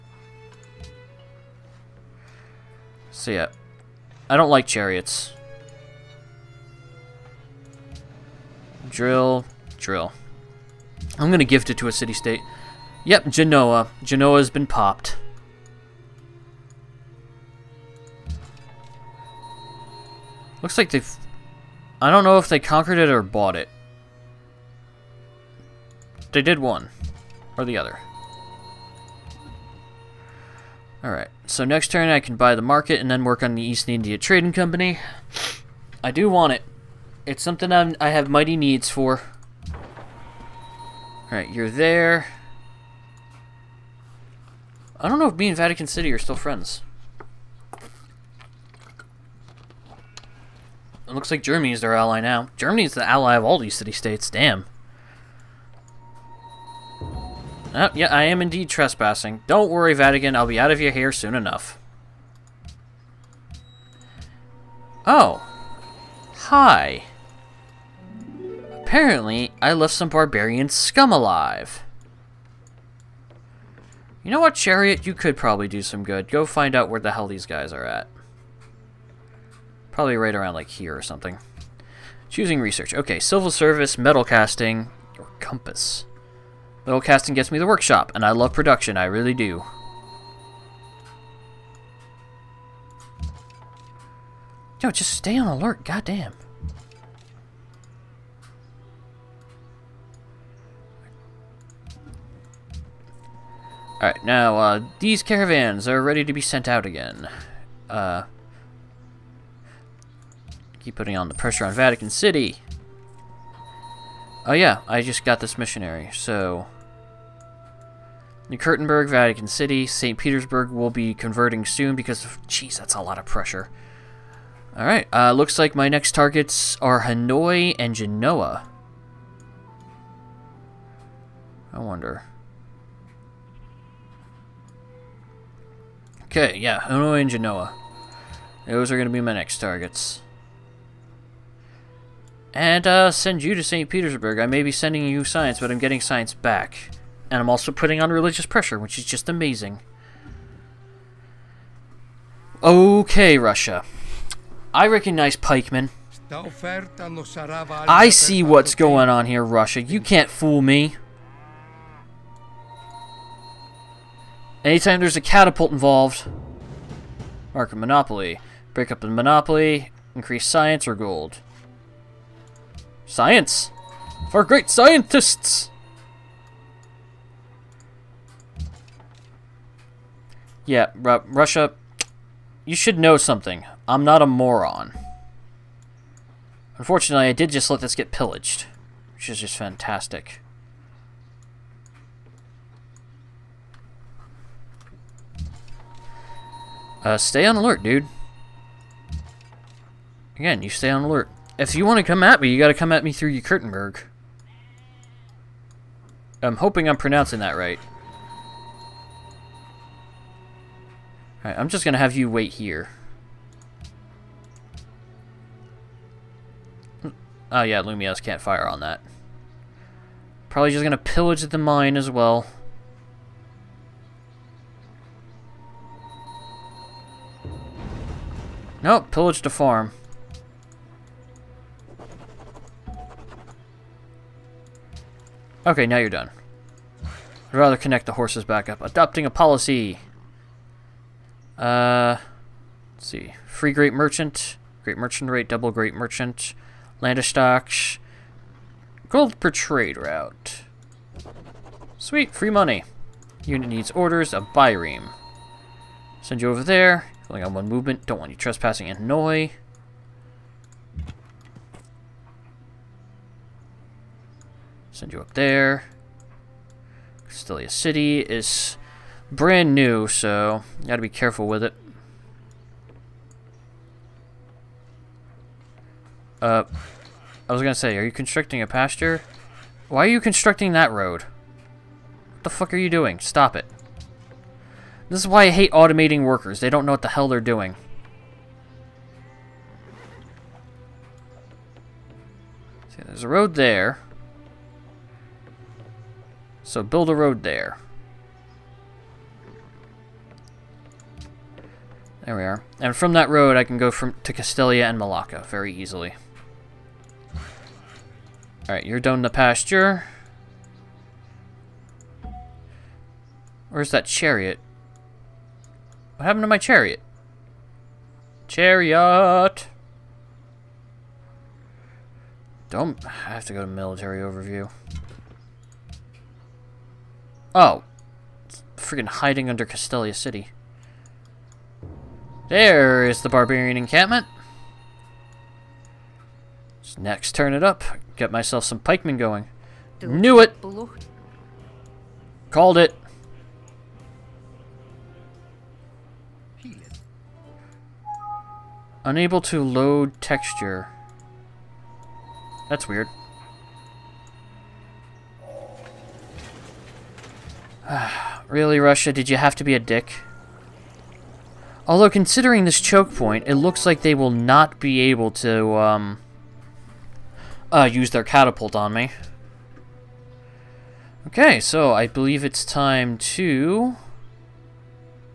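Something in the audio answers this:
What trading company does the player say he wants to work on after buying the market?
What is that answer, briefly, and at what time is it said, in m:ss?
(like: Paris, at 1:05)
East India Trading Company, at 0:33.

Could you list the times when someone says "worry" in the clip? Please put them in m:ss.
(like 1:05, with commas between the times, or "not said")
0:59.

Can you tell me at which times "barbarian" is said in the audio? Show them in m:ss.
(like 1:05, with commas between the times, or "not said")
1:10, 5:33.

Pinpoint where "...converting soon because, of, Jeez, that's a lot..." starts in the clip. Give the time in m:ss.
2:01.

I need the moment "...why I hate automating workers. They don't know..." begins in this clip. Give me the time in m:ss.
4:45.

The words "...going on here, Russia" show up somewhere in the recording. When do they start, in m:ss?
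2:38.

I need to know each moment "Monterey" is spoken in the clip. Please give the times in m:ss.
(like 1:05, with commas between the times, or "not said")
not said.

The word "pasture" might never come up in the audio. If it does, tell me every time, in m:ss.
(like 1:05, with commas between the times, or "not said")
4:38, 5:09.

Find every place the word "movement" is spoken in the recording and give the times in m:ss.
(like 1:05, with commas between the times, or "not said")
4:17.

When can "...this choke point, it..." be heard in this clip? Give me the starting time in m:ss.
6:02.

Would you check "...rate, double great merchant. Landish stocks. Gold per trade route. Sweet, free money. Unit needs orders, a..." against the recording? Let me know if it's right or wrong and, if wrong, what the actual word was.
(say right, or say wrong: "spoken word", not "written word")
right.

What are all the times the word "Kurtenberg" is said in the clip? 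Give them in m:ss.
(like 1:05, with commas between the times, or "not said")
1:58, 3:23.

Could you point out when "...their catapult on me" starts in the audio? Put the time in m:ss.
6:08.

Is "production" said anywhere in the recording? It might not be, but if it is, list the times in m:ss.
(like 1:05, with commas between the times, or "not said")
1:28.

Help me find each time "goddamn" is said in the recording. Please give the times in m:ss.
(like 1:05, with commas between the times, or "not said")
1:35.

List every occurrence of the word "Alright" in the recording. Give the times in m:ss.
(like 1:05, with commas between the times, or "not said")
0:31, 0:41, 1:44, 2:04, 3:31, 5:08.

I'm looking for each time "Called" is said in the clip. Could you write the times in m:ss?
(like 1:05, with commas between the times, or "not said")
5:42.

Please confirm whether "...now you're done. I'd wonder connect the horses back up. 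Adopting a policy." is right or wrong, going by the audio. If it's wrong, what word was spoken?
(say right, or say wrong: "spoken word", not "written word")
wrong: "rather", not "wonder".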